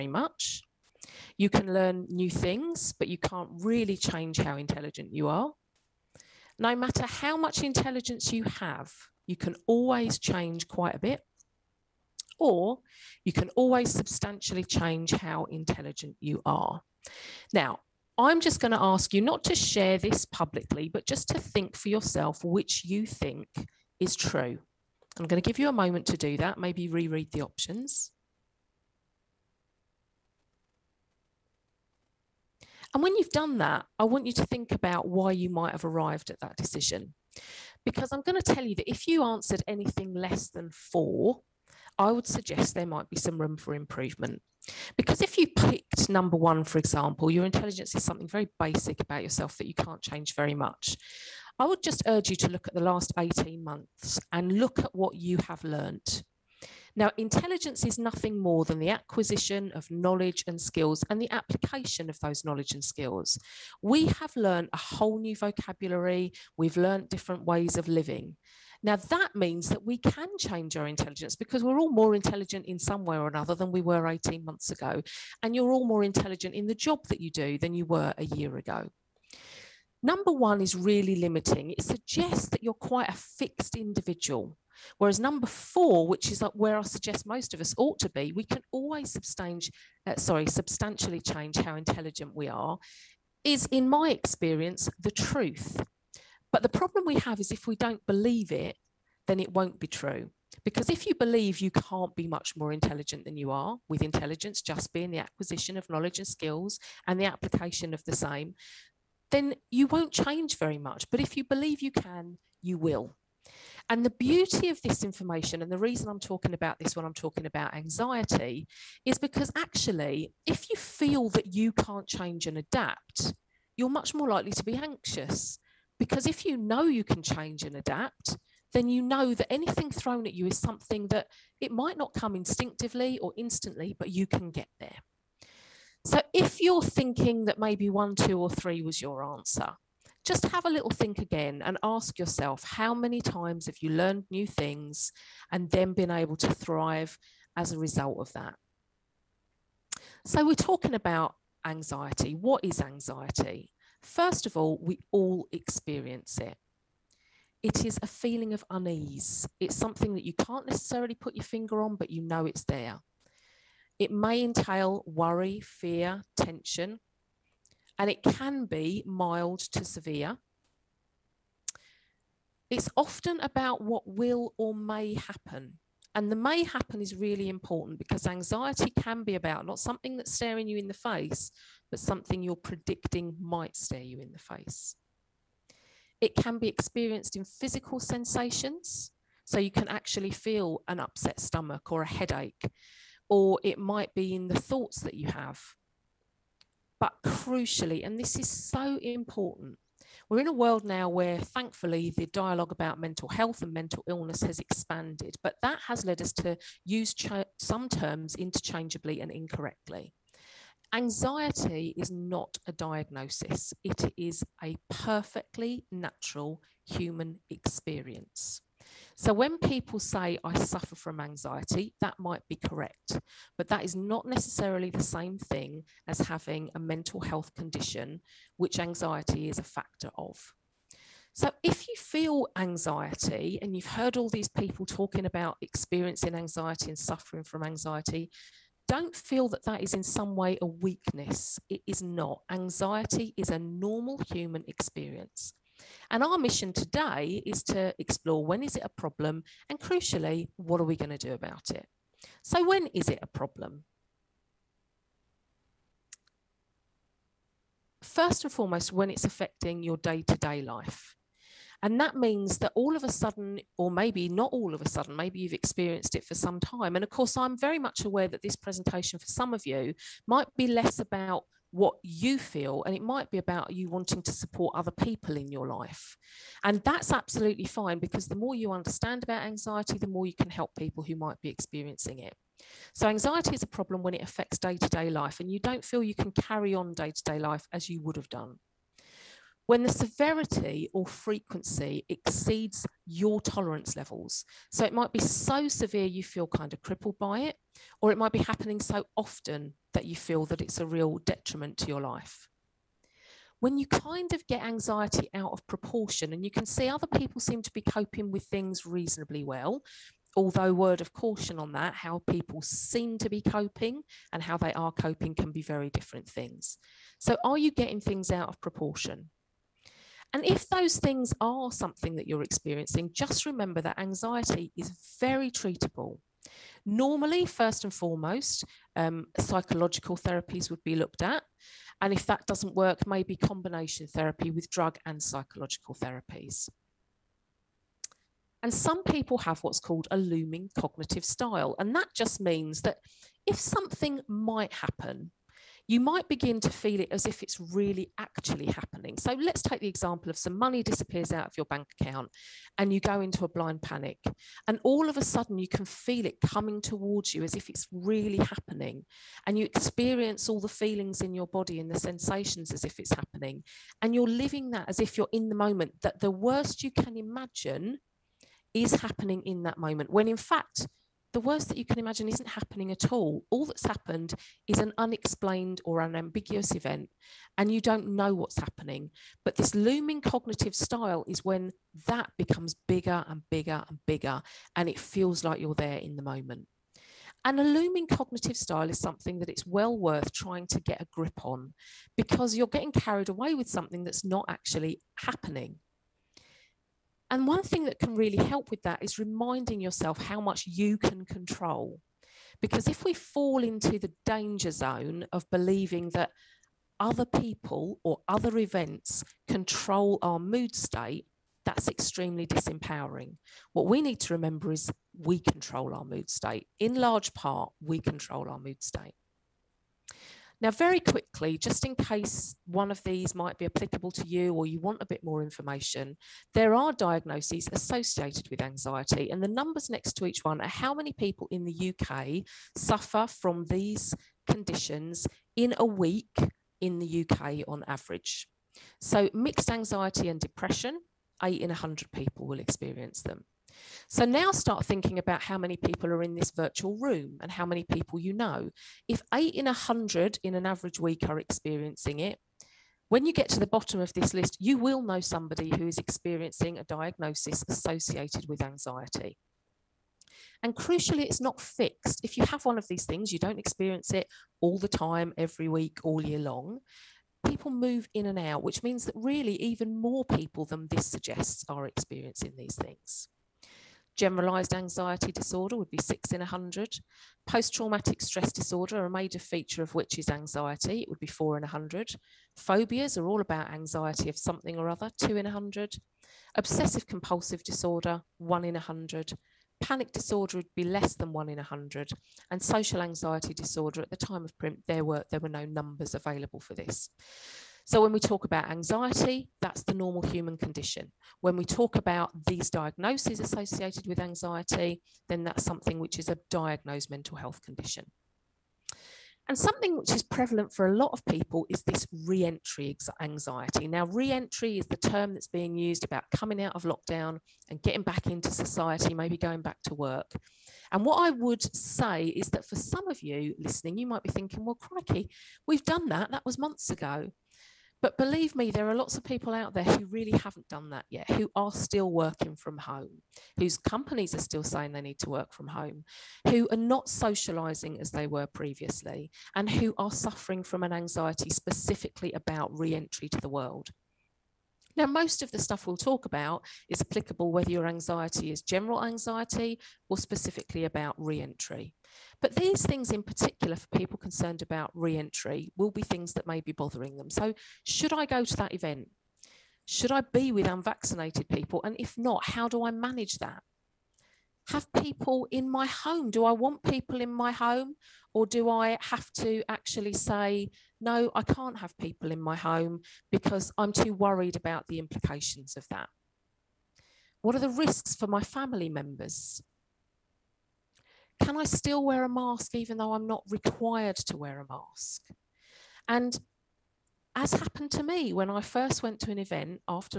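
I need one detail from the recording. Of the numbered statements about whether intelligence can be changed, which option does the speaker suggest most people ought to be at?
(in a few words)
Number four.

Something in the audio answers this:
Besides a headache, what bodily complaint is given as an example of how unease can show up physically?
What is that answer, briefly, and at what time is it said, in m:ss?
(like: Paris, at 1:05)
Upset stomach, at 3:10.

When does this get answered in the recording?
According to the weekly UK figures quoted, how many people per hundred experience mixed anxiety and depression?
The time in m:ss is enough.
7:21.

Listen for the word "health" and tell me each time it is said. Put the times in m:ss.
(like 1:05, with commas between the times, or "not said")
3:23, 3:47, 8:27.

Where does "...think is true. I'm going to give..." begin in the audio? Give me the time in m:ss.
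0:23.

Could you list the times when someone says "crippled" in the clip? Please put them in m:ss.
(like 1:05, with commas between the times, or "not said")
4:56.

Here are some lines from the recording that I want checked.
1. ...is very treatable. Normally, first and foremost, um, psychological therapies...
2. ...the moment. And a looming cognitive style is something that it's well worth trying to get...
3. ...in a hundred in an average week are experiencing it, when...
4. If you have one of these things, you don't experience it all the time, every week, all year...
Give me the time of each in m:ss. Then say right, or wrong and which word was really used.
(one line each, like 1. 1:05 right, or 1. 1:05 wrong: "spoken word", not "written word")
1. 5:24 right
2. 6:26 right
3. 7:29 right
4. 7:42 right.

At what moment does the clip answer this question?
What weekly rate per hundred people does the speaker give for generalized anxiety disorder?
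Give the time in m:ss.
7:56.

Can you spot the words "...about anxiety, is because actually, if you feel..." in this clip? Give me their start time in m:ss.
1:57.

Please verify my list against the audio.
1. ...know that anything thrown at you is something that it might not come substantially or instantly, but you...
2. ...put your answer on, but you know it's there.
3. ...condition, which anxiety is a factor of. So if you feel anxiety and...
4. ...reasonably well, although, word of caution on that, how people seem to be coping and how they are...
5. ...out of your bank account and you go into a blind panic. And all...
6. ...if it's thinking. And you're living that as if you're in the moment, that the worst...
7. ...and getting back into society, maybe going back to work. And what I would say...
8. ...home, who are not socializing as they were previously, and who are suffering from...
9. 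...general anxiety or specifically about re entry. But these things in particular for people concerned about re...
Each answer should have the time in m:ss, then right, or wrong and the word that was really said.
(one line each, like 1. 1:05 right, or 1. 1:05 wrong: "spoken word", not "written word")
1. 2:09 wrong: "instinctively", not "substantially"
2. 2:41 wrong: "finger", not "answer"
3. 3:47 right
4. 5:08 right
5. 5:51 right
6. 6:02 wrong: "happening", not "thinking"
7. 8:37 right
8. 8:55 right
9. 9:08 right.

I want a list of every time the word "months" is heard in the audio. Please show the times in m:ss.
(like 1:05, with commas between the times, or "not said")
0:53, 1:14, 8:46.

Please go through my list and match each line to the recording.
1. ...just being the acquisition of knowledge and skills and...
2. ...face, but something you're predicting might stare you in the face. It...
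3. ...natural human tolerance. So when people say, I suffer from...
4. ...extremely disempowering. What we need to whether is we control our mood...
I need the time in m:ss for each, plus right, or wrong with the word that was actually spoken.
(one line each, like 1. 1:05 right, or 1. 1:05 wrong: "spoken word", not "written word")
1. 1:44 right
2. 3:00 right
3. 3:35 wrong: "experience", not "tolerance"
4. 6:51 wrong: "remember", not "whether".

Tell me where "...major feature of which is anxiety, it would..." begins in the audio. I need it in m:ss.
7:59.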